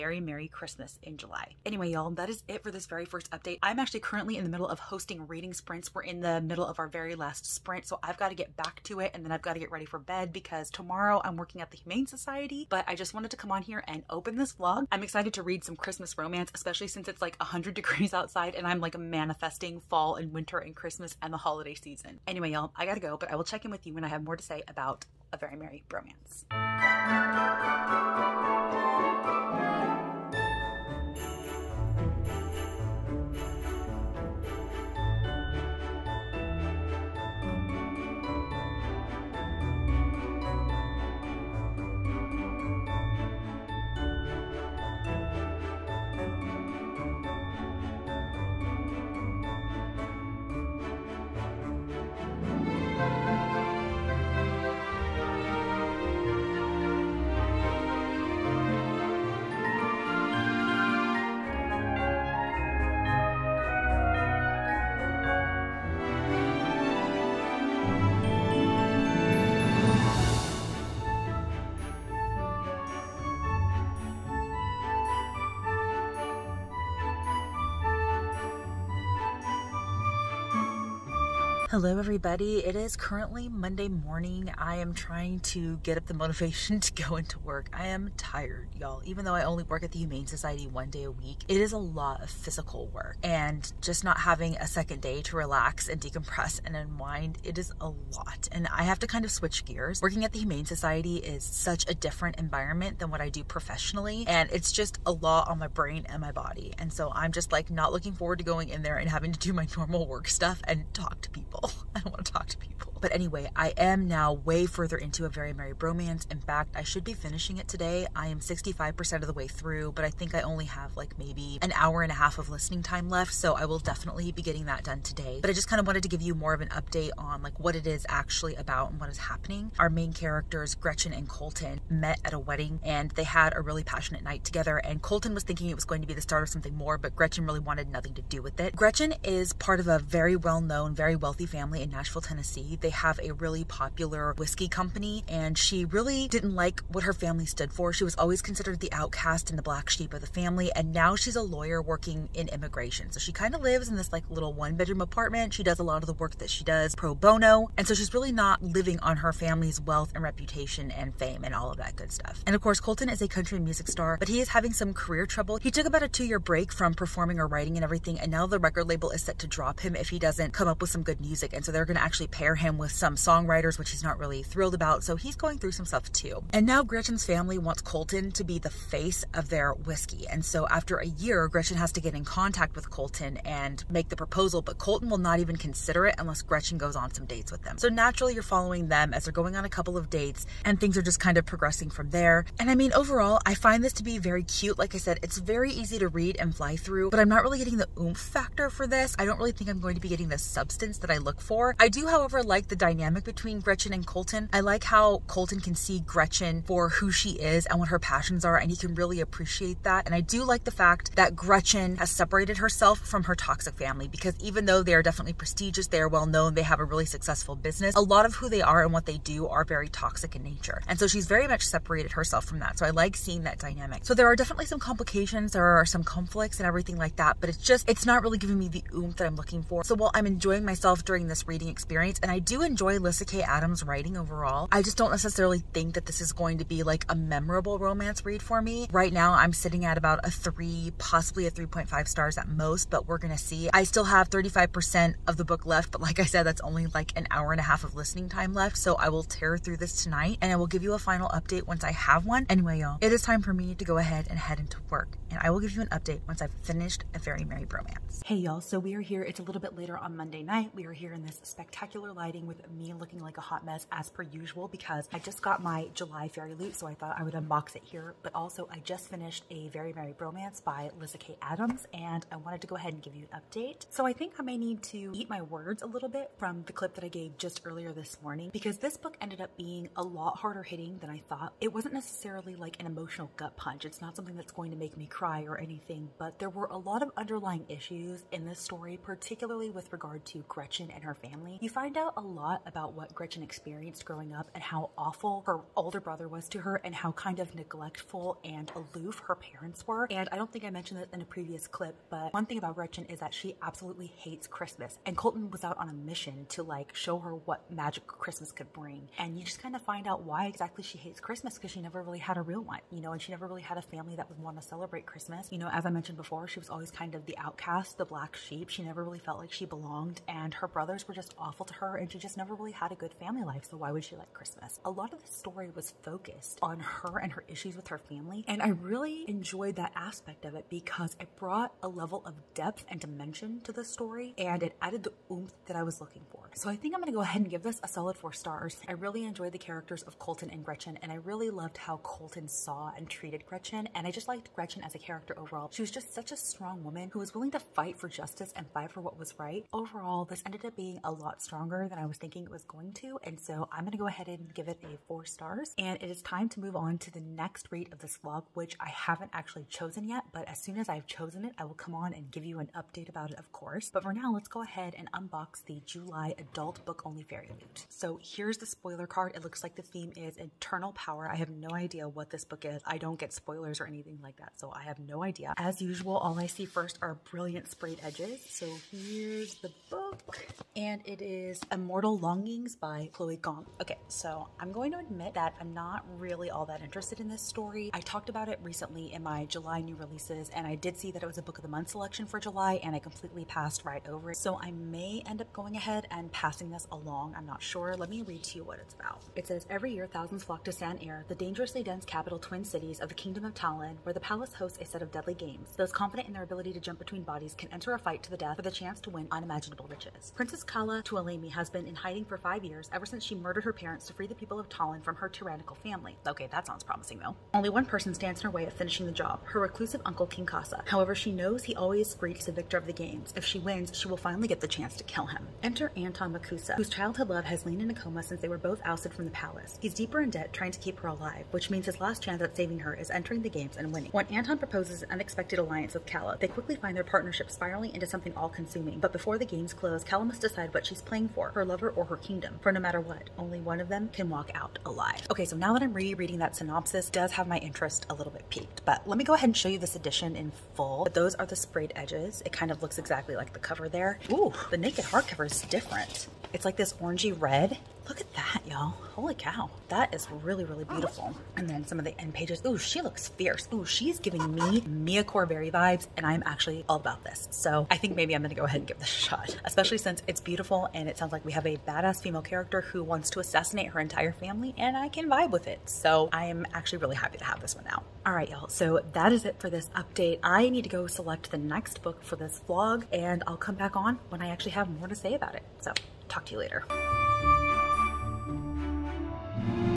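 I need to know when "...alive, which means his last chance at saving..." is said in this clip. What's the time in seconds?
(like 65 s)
431 s.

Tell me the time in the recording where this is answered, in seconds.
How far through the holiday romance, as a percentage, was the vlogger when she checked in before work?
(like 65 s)
118 s.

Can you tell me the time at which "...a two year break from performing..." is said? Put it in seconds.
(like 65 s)
166 s.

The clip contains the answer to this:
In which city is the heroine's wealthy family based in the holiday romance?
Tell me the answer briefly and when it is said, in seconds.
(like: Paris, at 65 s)
Nashville, at 141 s.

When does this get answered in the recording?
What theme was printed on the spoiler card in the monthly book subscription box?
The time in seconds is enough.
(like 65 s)
370 s.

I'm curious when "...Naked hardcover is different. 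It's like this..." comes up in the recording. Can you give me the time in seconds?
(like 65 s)
454 s.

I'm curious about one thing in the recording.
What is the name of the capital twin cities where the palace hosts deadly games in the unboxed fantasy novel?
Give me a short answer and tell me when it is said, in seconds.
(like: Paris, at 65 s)
San-Er, at 400 s.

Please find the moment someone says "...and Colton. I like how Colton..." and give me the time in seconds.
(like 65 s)
203 s.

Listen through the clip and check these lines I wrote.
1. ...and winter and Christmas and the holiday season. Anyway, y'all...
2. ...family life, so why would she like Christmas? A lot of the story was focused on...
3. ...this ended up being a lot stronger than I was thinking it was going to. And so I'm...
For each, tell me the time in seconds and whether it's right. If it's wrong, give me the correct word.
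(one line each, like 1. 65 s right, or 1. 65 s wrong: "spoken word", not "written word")
1. 20 s right
2. 323 s right
3. 350 s right.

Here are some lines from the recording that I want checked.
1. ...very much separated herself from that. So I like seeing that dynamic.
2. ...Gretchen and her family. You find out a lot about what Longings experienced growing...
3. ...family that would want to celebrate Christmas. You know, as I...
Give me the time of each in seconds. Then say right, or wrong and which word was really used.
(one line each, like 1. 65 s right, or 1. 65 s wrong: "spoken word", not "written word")
1. 221 s right
2. 290 s wrong: "Gretchen", not "Longings"
3. 313 s right.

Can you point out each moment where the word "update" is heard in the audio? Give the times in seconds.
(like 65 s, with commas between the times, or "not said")
3 s, 126 s, 251 s, 255 s, 273 s, 362 s, 479 s.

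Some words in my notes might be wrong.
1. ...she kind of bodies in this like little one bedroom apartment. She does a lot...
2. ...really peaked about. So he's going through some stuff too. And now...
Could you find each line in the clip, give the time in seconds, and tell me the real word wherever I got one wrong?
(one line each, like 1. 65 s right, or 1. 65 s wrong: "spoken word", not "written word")
1. 153 s wrong: "lives", not "bodies"
2. 174 s wrong: "thrilled", not "peaked".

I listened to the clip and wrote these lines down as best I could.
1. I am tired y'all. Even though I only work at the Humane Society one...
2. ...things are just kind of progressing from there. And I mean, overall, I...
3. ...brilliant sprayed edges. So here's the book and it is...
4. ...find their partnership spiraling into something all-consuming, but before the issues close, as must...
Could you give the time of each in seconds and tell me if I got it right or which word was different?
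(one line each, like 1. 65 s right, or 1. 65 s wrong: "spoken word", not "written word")
1. 87 s right
2. 190 s right
3. 377 s right
4. 436 s wrong: "games", not "issues".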